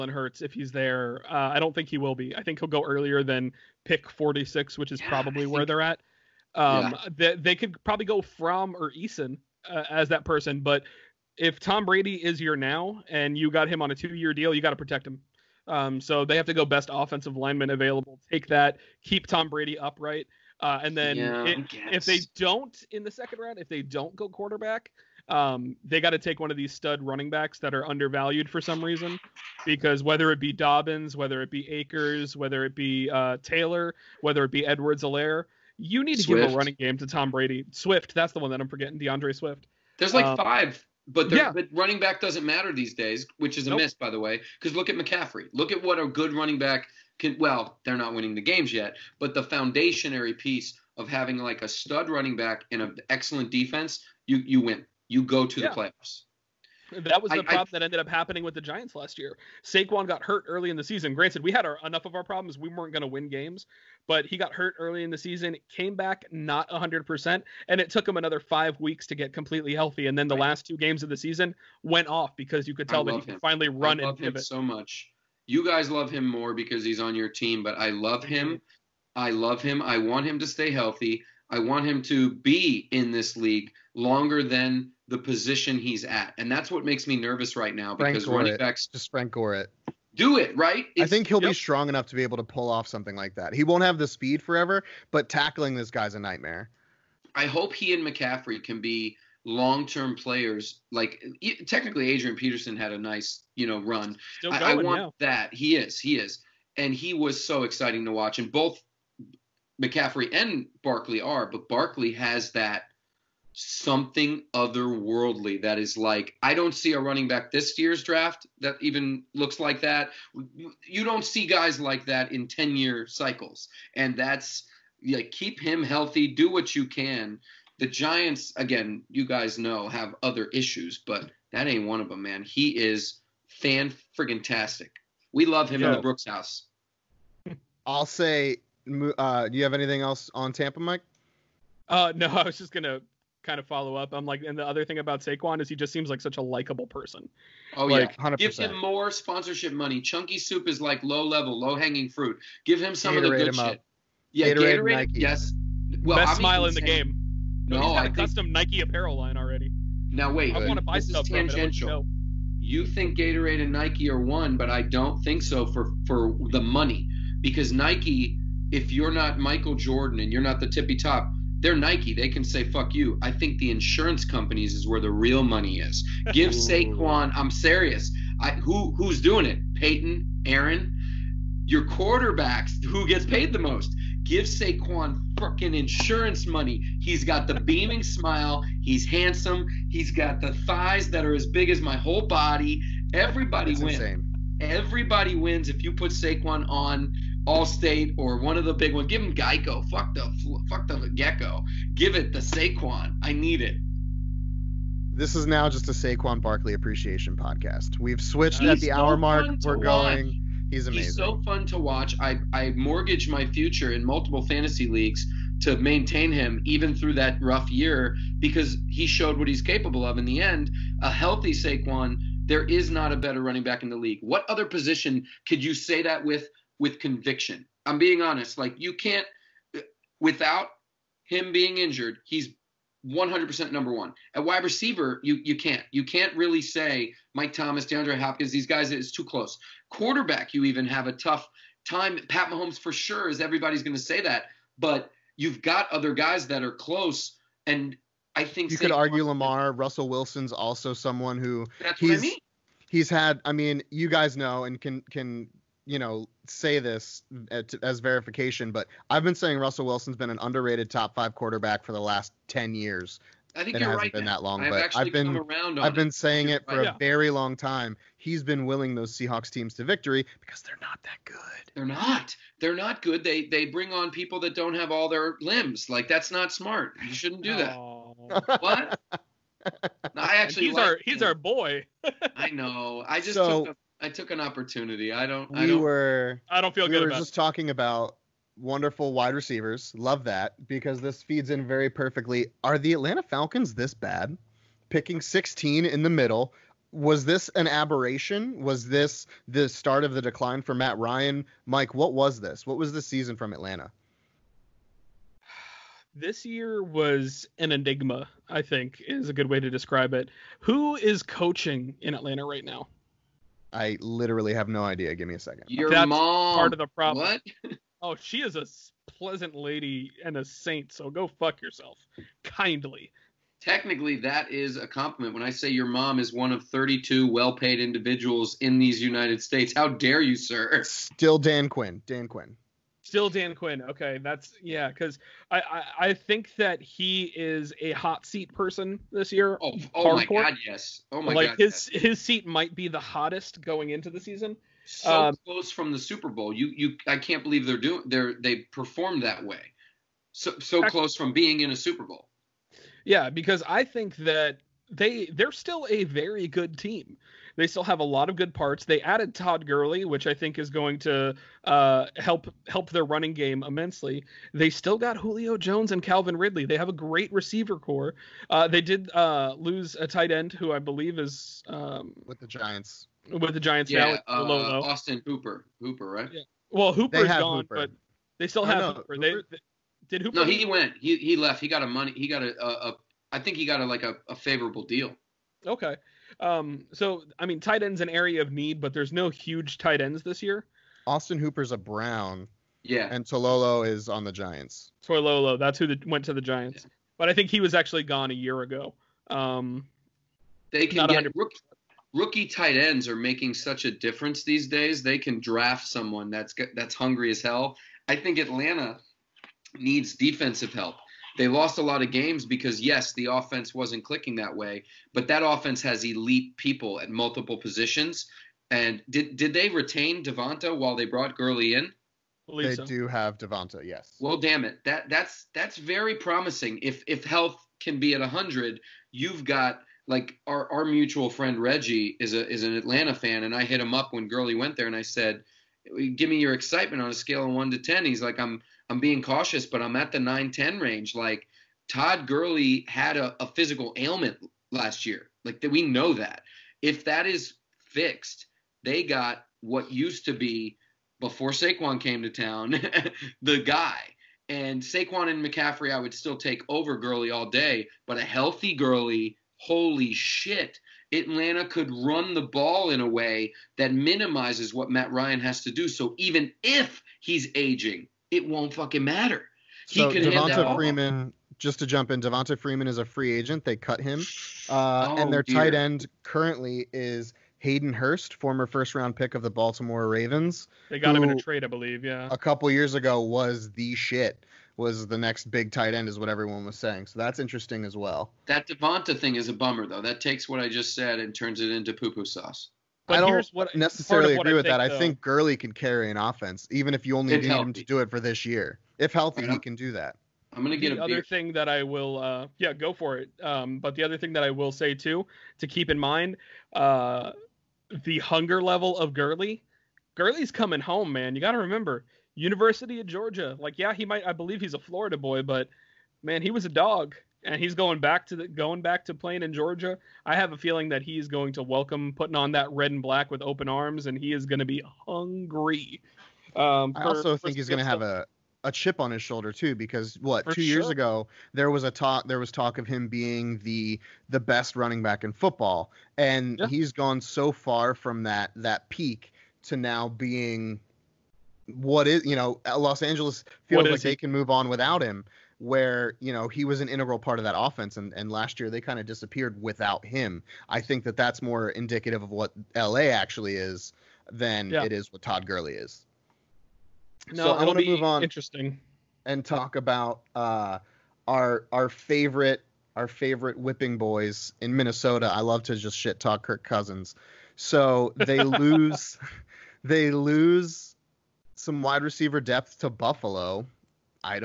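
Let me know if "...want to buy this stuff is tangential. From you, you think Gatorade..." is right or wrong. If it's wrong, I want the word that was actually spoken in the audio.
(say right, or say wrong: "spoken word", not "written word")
right.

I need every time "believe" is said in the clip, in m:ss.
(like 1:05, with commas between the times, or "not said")
5:47, 6:10, 8:01, 8:34.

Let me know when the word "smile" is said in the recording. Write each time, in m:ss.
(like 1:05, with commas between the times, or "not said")
2:36, 3:08.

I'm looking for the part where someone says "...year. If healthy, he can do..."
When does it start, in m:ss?
8:18.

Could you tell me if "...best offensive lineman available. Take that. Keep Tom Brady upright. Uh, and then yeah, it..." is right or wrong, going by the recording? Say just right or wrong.
right.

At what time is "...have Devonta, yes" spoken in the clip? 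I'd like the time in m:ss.
7:03.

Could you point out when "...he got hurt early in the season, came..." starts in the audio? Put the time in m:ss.
1:04.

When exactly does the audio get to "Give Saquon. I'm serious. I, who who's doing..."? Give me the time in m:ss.
2:56.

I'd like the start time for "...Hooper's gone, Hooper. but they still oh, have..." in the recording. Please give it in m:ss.
6:16.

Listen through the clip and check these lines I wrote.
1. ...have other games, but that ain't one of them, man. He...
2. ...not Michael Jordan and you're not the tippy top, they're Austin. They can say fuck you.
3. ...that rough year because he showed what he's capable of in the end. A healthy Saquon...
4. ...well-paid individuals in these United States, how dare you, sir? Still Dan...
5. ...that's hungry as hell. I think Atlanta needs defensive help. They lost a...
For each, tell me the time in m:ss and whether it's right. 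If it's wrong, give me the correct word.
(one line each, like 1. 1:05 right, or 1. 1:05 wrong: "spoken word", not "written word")
1. 2:09 wrong: "issues", not "games"
2. 2:49 wrong: "Nike", not "Austin"
3. 3:37 right
4. 5:27 right
5. 6:46 right.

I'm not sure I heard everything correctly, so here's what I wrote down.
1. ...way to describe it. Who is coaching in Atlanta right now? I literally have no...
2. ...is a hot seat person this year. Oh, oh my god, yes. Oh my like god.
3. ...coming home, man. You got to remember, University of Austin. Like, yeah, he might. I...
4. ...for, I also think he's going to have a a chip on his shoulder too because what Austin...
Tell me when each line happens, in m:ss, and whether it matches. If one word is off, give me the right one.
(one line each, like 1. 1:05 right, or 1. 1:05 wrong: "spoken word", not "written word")
1. 5:09 right
2. 5:37 right
3. 8:30 wrong: "Georgia", not "Austin"
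4. 8:46 wrong: "For", not "Austin".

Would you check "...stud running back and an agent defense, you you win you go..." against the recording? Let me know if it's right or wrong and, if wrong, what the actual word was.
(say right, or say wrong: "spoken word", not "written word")
wrong: "excellent", not "agent".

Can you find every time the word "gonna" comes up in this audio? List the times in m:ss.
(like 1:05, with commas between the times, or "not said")
2:22, 8:20.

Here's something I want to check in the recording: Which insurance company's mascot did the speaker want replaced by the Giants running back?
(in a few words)
Geico.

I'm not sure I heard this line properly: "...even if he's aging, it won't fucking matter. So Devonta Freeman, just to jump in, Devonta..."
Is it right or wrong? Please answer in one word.
right.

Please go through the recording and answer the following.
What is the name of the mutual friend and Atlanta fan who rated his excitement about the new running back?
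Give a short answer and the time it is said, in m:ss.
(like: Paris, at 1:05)
Reggie, at 7:11.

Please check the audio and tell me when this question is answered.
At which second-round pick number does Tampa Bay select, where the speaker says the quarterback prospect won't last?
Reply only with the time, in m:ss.
0:03.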